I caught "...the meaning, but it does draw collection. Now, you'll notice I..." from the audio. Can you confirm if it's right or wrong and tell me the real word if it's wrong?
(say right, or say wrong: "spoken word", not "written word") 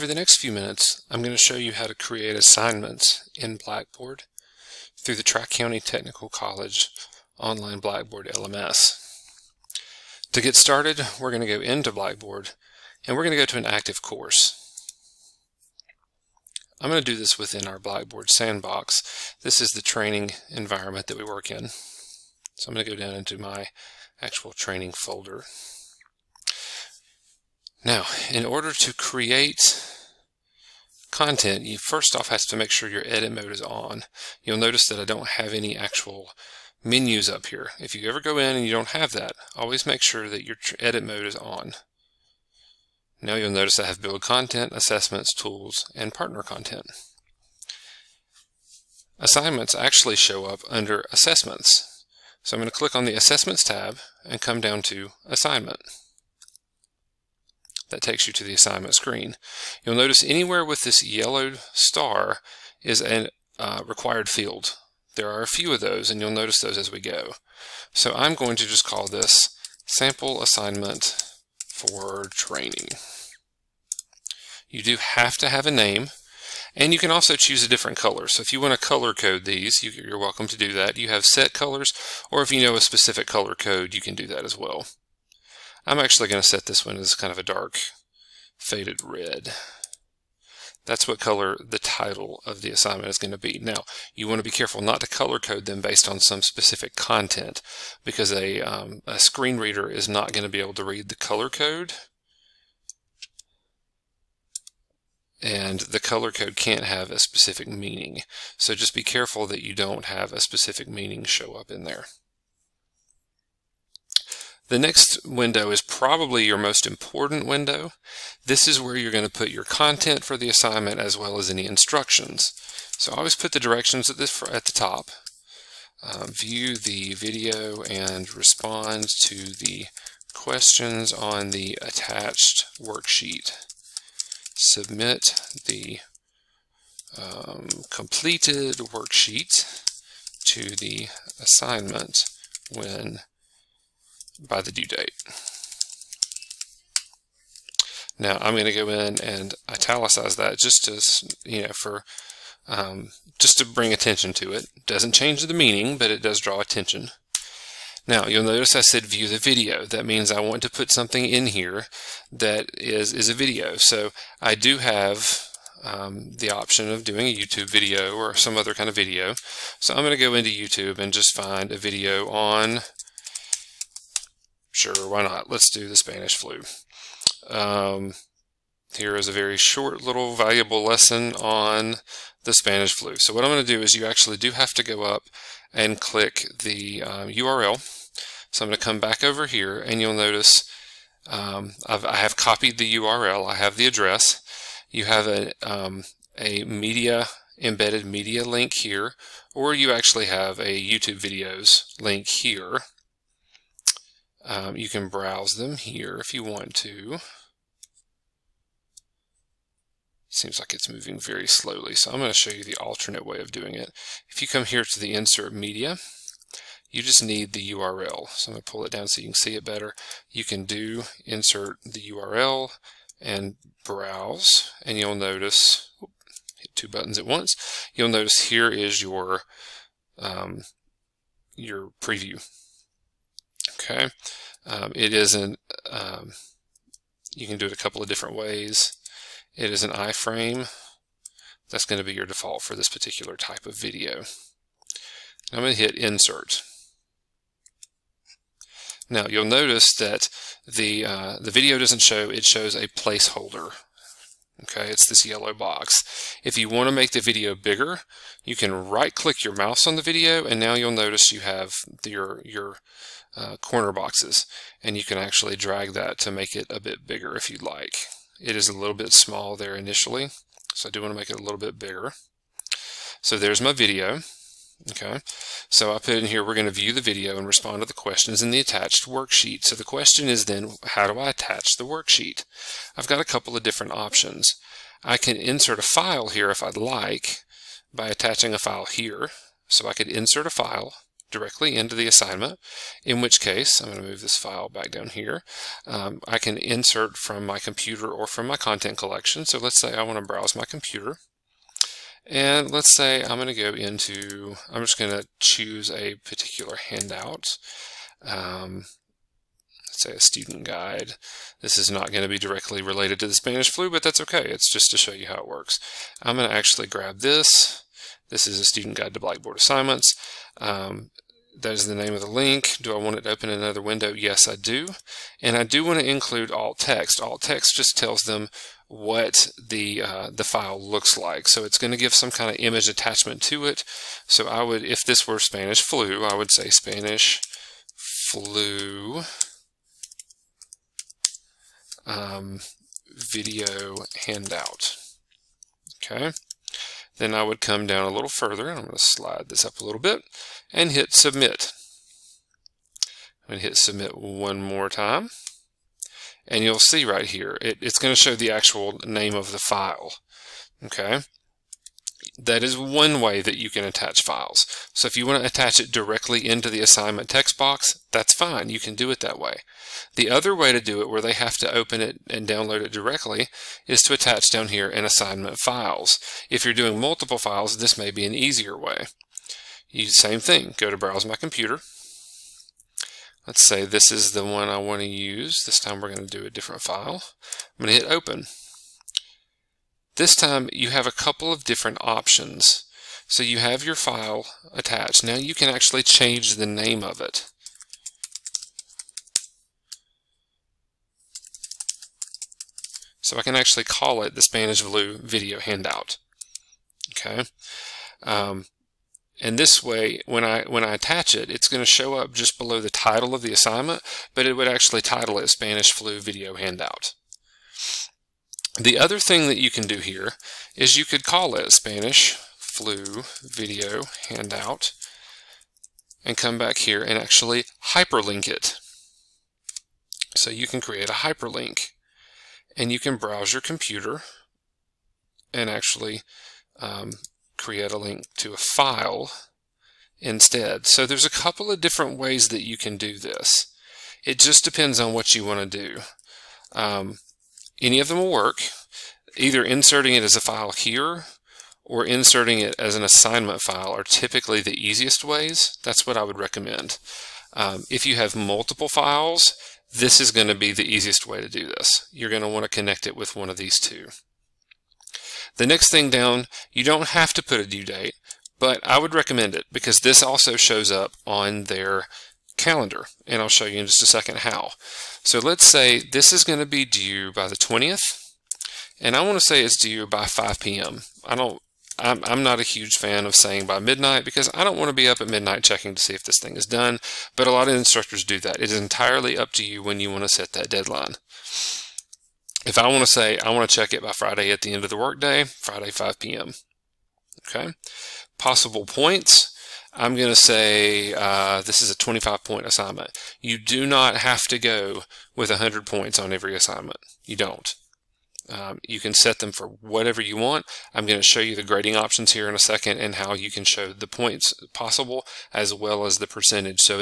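wrong: "attention", not "collection".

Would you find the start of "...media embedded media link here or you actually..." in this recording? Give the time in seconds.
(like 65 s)
196 s.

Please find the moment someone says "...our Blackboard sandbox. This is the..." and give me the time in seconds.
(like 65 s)
17 s.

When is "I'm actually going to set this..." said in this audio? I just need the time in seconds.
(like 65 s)
85 s.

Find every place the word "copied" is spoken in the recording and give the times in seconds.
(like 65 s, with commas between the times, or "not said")
192 s.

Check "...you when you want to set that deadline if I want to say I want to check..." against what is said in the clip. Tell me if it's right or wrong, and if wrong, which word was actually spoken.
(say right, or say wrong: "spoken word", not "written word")
right.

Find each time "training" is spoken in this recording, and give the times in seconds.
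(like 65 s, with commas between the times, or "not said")
19 s, 24 s, 72 s.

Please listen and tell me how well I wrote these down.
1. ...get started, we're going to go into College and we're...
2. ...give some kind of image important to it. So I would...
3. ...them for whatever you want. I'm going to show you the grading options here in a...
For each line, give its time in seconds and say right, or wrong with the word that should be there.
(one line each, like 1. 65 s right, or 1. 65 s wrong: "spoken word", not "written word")
1. 10 s wrong: "Blackboard", not "College"
2. 331 s wrong: "attachment", not "important"
3. 509 s right.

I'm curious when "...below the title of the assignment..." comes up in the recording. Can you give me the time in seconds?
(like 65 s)
412 s.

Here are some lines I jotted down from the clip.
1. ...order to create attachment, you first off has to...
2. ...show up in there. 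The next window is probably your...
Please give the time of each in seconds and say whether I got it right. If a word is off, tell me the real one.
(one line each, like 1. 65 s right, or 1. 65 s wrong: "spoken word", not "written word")
1. 28 s wrong: "content", not "attachment"
2. 111 s right.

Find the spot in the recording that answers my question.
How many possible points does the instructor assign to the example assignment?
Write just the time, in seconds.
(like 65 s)
501 s.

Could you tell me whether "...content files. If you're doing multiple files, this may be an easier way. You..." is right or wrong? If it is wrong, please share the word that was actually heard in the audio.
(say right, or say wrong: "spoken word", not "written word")
wrong: "assignment", not "content".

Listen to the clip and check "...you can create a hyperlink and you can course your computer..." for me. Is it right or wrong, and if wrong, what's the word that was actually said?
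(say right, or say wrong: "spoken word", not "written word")
wrong: "browse", not "course".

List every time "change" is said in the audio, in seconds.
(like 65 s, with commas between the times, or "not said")
155 s, 396 s.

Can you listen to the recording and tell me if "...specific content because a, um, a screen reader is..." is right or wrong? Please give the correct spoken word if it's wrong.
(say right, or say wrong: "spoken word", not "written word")
right.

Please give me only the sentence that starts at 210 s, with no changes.
Seems like it's moving very slowly, so I'm going to show you the alternate way of doing it.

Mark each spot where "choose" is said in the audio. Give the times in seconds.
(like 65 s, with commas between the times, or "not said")
77 s, 305 s.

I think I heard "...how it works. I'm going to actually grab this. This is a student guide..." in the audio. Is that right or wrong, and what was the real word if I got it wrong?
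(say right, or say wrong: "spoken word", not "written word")
right.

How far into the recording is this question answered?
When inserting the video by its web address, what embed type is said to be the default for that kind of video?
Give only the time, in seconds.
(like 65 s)
239 s.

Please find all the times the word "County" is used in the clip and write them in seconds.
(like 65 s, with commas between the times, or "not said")
5 s.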